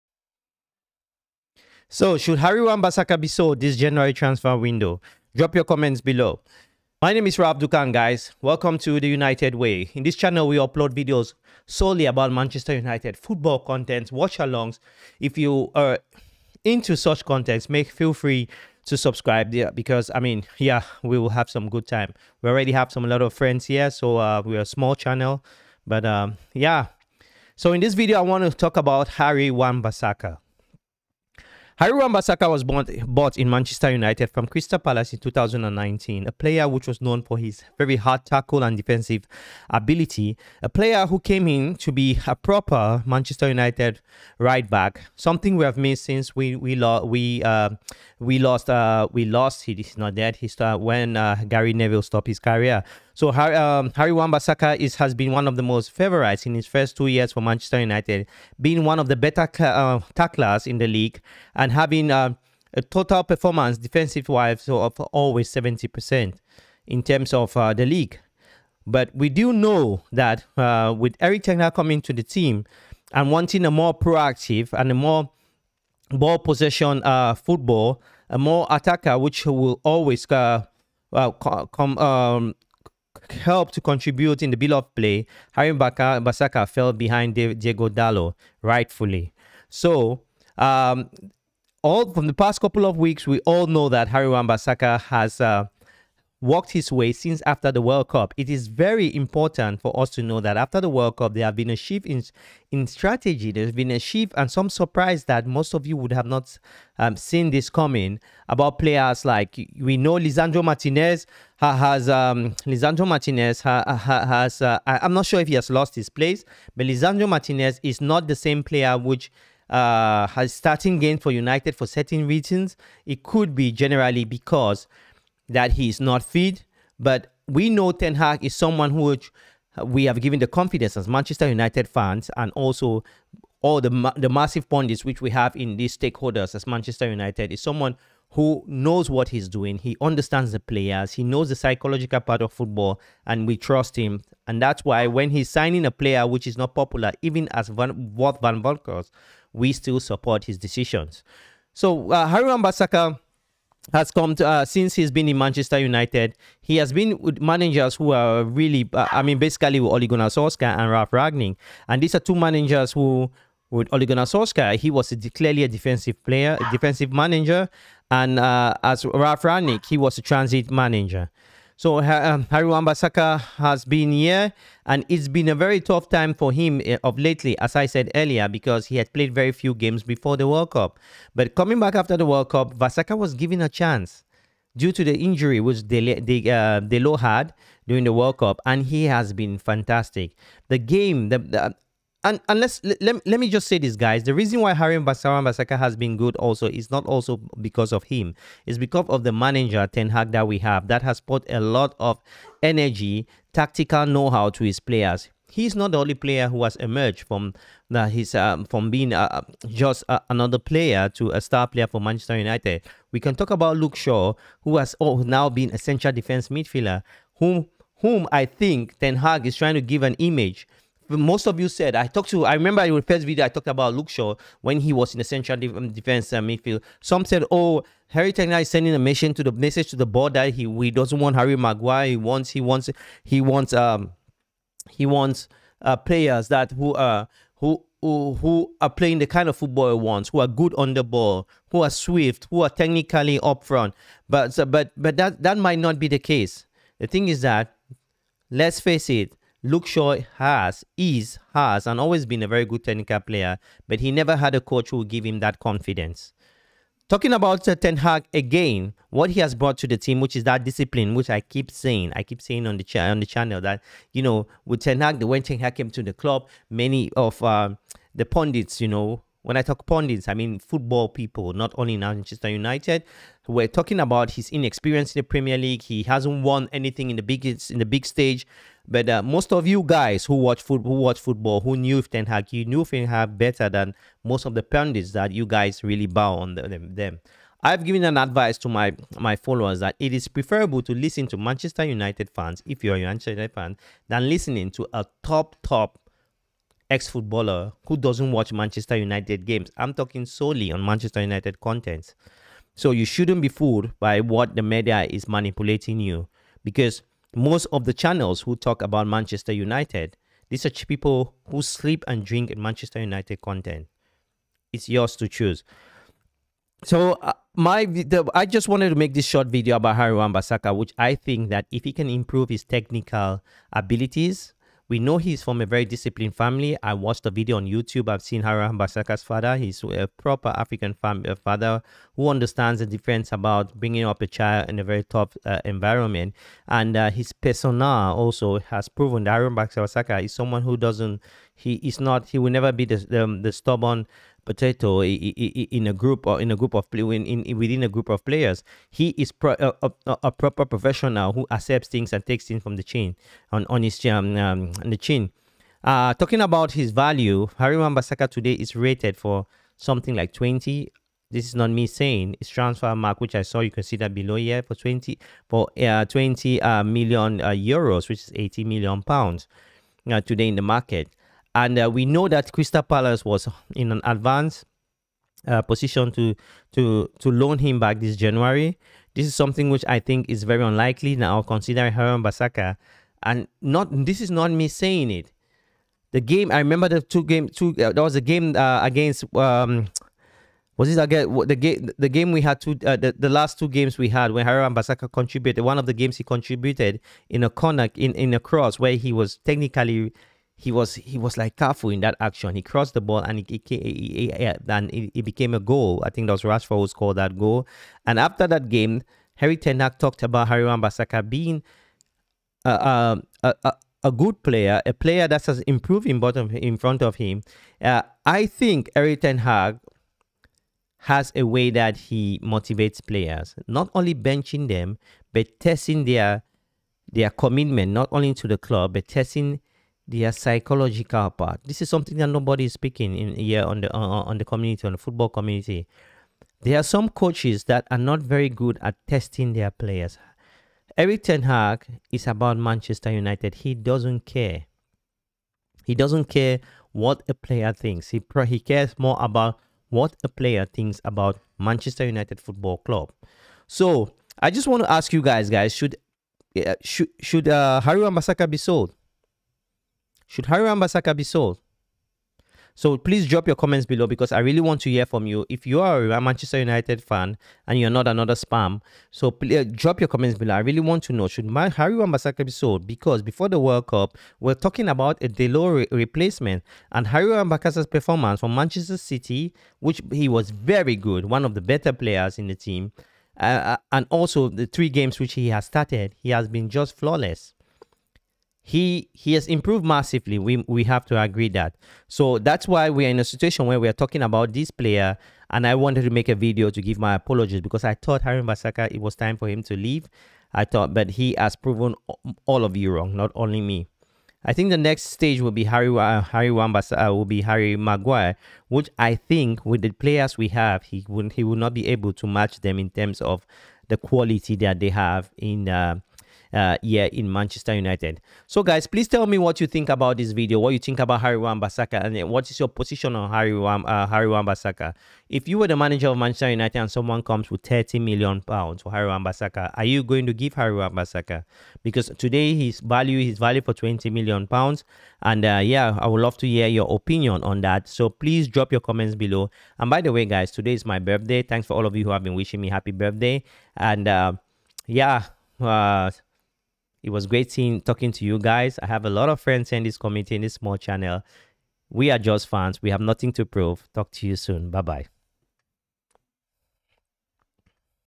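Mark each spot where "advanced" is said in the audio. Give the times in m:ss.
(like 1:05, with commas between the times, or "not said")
6:14.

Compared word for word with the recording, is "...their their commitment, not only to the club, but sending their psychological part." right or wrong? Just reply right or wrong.
wrong.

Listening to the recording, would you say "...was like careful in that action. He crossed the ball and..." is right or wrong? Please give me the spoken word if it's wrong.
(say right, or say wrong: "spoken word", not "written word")
right.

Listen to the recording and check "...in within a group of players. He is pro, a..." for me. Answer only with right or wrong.
right.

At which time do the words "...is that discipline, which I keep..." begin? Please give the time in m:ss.
4:20.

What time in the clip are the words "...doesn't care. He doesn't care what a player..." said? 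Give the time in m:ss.
7:23.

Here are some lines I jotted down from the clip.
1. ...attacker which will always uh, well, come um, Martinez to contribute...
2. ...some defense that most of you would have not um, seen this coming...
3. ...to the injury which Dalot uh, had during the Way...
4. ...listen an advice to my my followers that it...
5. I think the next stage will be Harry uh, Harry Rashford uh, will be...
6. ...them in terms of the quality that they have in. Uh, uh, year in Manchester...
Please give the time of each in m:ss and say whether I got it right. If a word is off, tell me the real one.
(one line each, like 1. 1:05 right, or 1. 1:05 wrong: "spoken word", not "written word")
1. 1:18 wrong: "Help", not "Martinez"
2. 1:44 wrong: "surprise", not "defense"
3. 3:04 wrong: "World", not "Way"
4. 4:47 wrong: "given", not "listen"
5. 8:24 wrong: "Wambas", not "Rashford"
6. 8:32 right.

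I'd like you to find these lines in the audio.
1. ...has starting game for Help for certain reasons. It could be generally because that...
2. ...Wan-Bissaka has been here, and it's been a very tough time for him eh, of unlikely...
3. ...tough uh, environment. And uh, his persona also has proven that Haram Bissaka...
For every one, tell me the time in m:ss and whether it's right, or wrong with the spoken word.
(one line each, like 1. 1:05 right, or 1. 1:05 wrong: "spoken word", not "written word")
1. 2:00 wrong: "United", not "Help"
2. 2:52 wrong: "lately", not "unlikely"
3. 5:35 right.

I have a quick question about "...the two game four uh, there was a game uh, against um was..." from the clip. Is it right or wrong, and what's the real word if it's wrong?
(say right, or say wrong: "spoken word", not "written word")
wrong: "two", not "four".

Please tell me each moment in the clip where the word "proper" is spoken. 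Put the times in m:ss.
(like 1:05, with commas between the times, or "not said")
0:42, 5:30, 5:50.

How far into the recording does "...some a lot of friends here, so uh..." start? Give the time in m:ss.
0:22.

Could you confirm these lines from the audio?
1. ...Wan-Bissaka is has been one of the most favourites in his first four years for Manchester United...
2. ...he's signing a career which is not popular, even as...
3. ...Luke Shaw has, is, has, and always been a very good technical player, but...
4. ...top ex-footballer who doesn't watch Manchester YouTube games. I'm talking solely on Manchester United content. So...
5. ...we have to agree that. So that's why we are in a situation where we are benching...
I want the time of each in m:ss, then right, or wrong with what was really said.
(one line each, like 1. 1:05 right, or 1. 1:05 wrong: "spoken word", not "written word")
1. 0:54 wrong: "two", not "four"
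2. 2:25 wrong: "player", not "career"
3. 4:09 right
4. 4:55 wrong: "United", not "YouTube"
5. 8:10 wrong: "talking", not "benching".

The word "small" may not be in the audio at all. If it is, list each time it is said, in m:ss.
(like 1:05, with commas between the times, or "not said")
0:24, 9:10.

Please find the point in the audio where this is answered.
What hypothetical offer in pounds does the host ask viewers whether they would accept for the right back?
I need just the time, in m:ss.
8:47.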